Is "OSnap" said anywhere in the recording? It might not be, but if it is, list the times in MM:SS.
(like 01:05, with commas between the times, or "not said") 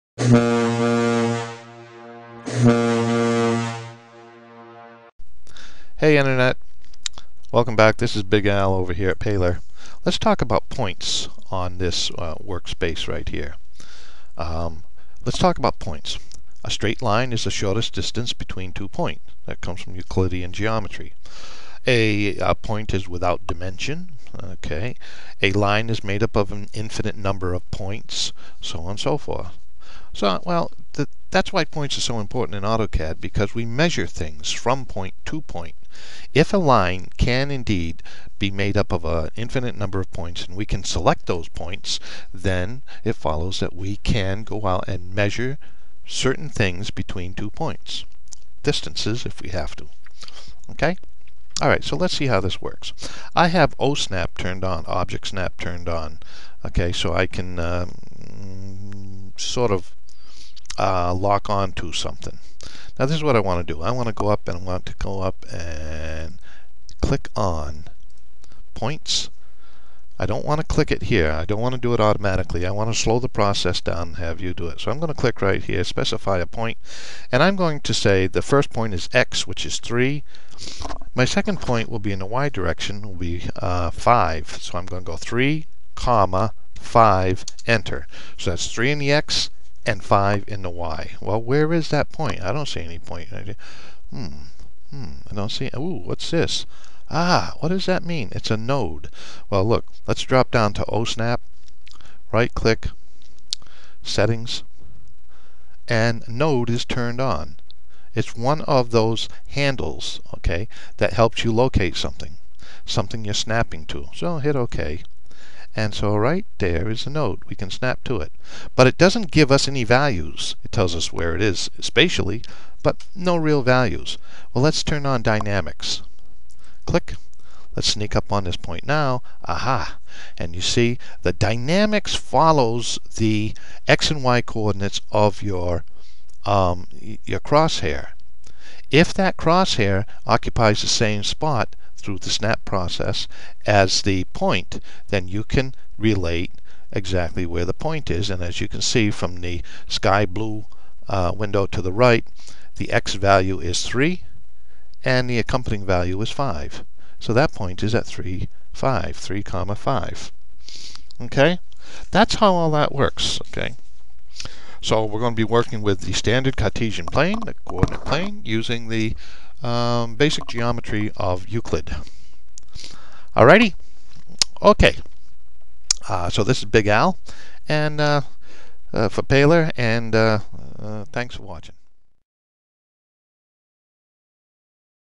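00:53, 01:40.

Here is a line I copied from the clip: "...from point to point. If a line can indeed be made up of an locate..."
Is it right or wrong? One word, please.
wrong.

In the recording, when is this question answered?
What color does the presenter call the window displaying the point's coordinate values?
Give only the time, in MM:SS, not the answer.
02:29.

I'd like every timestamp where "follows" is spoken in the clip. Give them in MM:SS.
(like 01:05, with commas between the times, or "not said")
00:43, 02:12.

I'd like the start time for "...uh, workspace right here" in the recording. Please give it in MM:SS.
00:12.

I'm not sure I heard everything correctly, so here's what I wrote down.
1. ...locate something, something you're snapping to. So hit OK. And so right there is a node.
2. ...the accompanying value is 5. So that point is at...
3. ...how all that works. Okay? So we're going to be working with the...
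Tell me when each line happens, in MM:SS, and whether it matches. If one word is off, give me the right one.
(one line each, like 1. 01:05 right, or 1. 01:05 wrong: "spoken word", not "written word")
1. 01:51 right
2. 02:35 right
3. 02:42 right.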